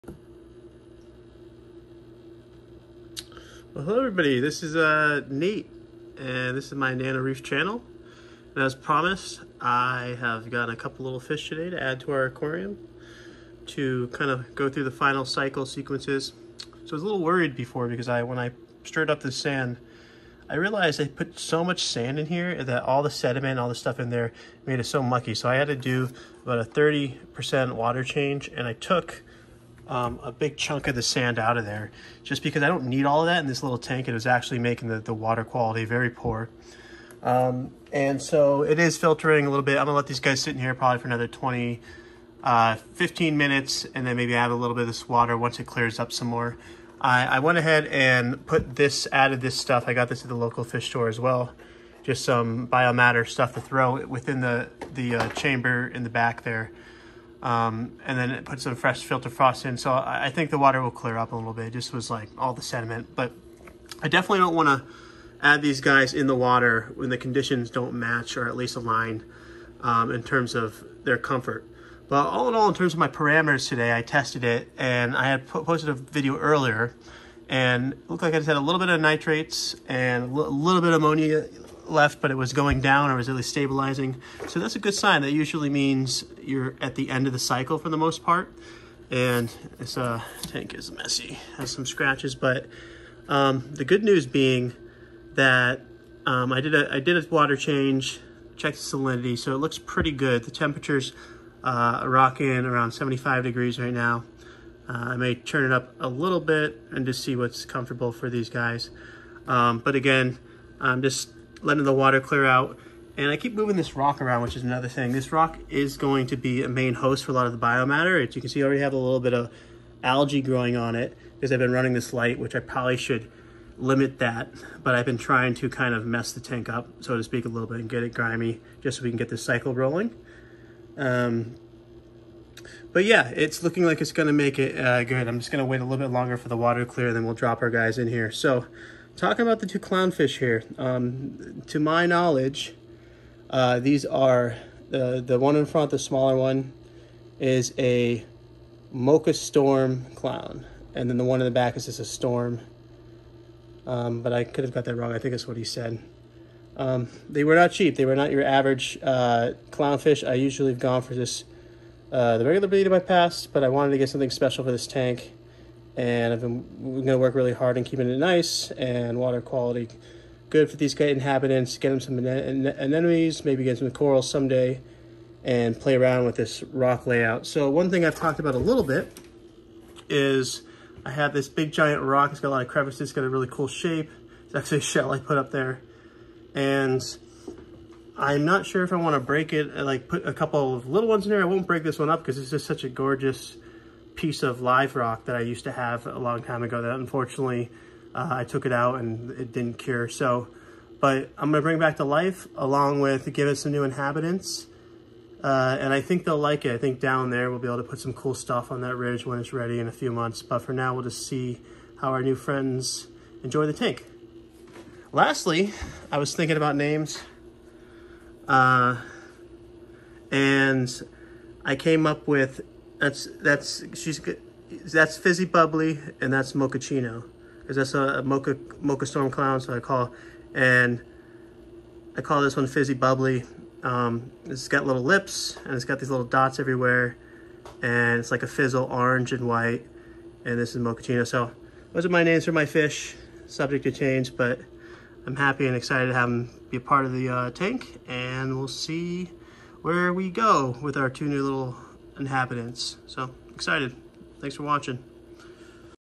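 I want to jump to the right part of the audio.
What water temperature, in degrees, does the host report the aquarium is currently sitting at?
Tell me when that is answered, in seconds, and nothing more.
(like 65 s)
102 s.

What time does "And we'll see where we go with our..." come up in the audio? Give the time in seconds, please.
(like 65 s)
248 s.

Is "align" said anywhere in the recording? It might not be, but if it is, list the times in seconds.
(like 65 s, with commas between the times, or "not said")
68 s.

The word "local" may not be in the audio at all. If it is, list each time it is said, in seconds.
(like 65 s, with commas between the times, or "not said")
50 s.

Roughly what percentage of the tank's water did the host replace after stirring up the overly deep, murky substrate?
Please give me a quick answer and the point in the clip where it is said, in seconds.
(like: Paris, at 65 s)
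30%, at 26 s.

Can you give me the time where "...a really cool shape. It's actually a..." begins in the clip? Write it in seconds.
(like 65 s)
183 s.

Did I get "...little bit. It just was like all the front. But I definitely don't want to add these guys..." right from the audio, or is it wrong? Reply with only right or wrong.
wrong.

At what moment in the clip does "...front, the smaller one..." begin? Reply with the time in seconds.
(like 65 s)
145 s.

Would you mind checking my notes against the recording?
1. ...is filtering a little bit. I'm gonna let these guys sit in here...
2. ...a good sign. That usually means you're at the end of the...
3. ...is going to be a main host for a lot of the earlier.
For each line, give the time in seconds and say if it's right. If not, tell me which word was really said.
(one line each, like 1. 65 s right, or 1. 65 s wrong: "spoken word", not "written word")
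1. 38 s right
2. 84 s right
3. 115 s wrong: "biomatter", not "earlier".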